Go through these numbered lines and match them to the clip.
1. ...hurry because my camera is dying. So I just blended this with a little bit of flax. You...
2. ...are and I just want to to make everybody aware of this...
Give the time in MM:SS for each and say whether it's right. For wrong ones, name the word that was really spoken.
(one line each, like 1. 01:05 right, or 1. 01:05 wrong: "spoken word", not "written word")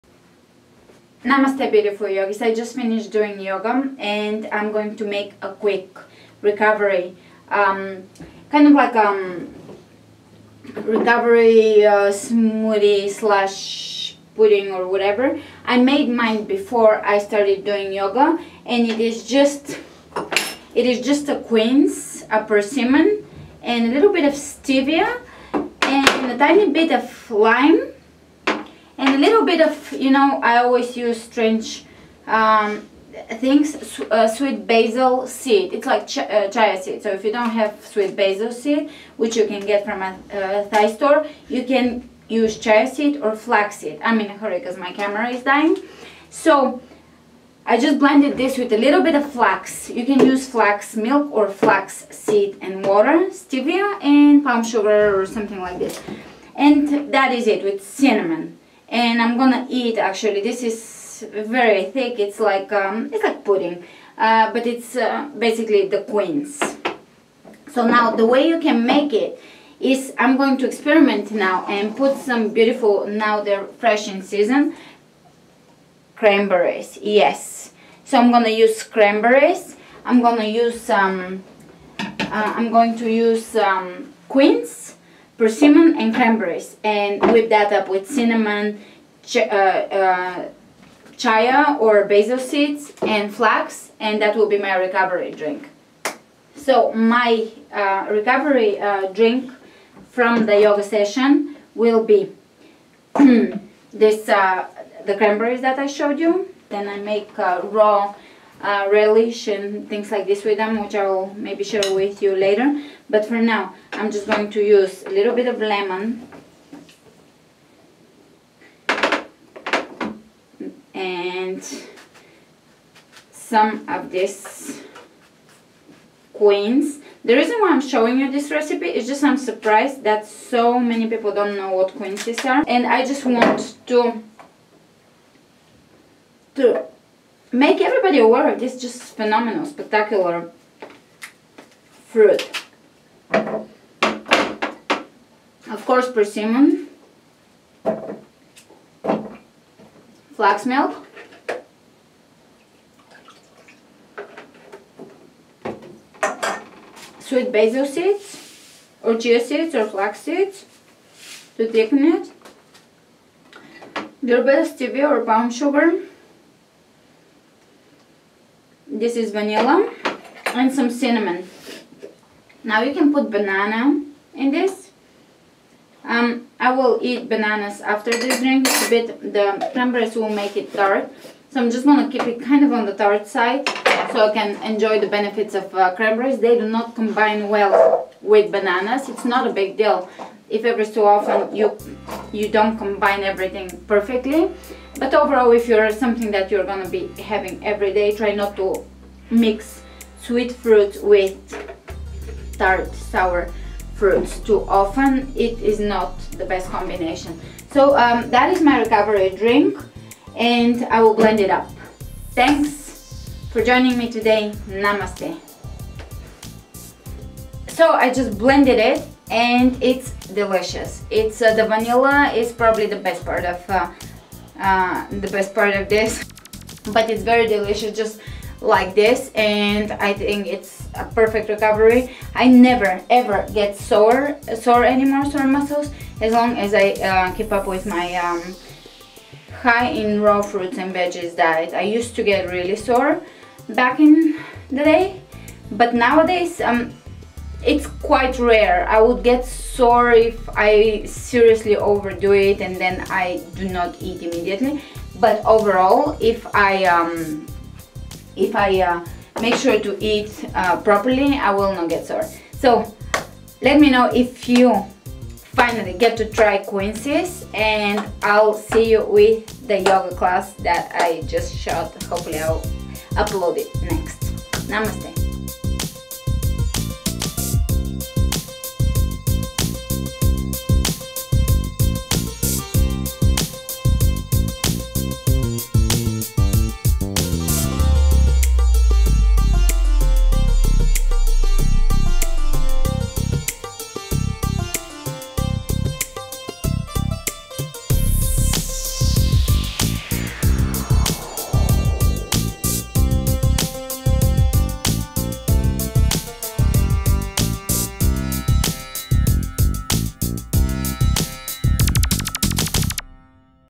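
1. 00:44 right
2. 02:12 right.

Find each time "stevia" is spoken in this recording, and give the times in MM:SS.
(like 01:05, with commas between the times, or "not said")
00:24, 00:53, 02:44.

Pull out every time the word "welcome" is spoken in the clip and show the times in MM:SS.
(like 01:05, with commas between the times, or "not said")
not said.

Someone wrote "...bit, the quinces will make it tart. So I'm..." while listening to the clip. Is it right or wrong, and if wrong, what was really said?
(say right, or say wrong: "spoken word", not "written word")
wrong: "cranberries", not "quinces".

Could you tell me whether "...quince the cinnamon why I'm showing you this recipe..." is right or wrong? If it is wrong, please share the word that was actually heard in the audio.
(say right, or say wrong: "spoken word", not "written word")
wrong: "reason", not "cinnamon".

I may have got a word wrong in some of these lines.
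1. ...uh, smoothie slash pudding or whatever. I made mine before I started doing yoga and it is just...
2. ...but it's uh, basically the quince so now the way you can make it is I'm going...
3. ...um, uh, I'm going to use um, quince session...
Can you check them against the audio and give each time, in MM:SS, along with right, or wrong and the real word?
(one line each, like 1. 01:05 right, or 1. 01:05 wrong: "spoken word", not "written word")
1. 00:11 right
2. 01:04 right
3. 01:21 wrong: "persimmon", not "session".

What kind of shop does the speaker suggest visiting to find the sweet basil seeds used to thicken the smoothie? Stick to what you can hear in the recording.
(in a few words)
Thai store.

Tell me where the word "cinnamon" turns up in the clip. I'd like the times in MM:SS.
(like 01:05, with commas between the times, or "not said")
00:57, 01:28, 02:50.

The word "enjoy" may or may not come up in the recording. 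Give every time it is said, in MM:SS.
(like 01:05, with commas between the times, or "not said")
03:04.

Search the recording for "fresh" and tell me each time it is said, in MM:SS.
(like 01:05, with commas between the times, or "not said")
01:13.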